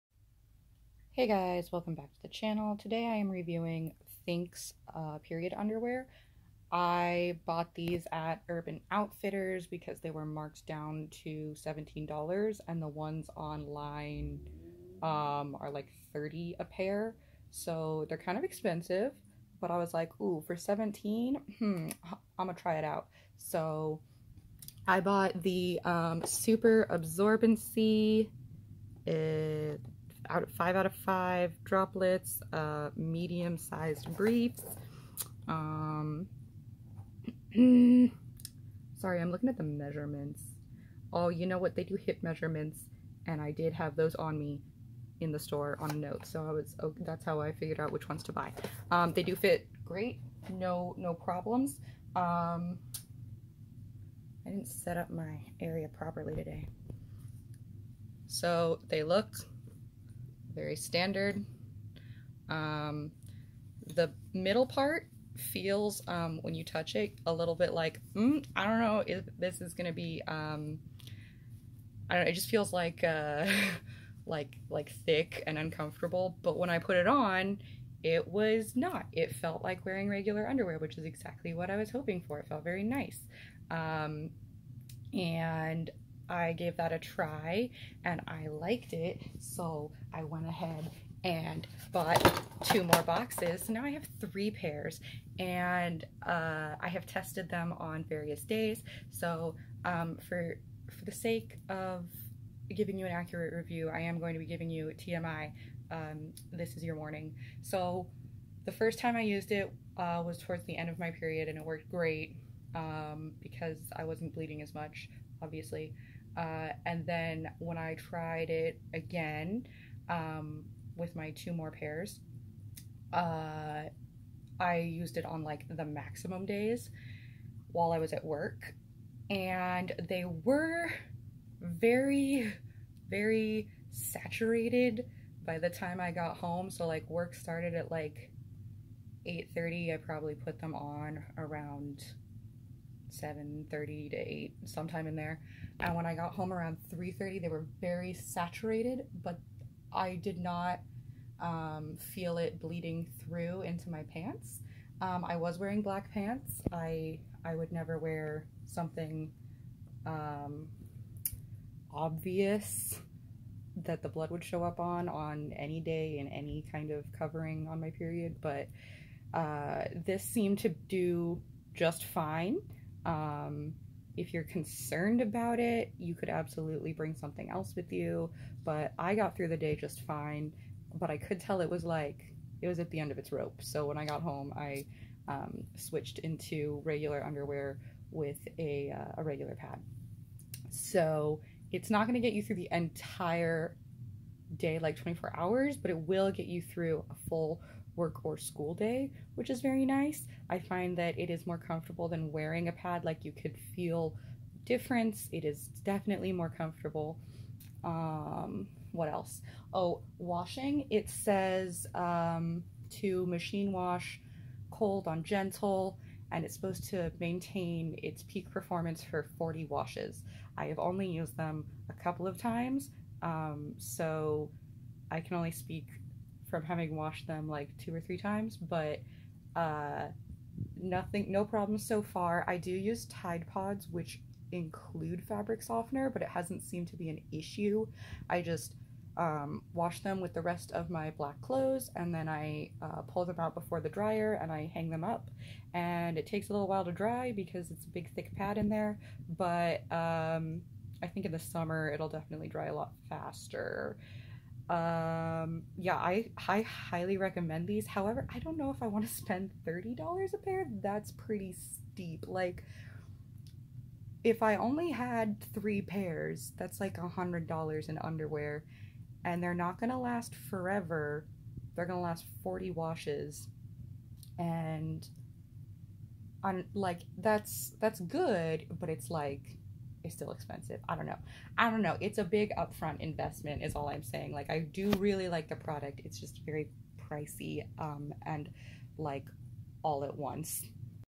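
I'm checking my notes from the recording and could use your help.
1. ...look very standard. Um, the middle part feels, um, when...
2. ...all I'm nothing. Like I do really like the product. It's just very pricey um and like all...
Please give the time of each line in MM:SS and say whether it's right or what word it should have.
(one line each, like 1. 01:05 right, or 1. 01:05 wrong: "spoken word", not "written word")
1. 00:59 right
2. 04:43 wrong: "saying", not "nothing".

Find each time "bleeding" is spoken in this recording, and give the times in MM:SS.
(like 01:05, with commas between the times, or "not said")
01:54, 02:32.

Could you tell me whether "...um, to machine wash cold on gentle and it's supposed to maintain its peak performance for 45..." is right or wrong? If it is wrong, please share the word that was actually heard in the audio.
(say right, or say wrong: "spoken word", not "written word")
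wrong: "40", not "45".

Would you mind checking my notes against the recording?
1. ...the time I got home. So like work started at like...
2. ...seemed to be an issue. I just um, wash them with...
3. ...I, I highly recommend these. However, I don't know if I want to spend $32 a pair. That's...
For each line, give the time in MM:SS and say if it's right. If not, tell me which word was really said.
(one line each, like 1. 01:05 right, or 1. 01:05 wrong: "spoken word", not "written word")
1. 02:15 right
2. 03:56 right
3. 04:15 wrong: "30", not "32".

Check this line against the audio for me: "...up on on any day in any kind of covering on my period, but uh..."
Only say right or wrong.
right.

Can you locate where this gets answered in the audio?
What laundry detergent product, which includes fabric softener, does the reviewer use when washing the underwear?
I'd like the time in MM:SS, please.
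03:53.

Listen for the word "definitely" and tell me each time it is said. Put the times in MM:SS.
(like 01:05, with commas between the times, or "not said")
03:25, 04:12.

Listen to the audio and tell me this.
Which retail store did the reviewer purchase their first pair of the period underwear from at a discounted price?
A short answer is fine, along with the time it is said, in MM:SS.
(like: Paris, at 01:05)
Urban Outfitters, at 00:08.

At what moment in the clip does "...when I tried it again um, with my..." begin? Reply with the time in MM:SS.
01:57.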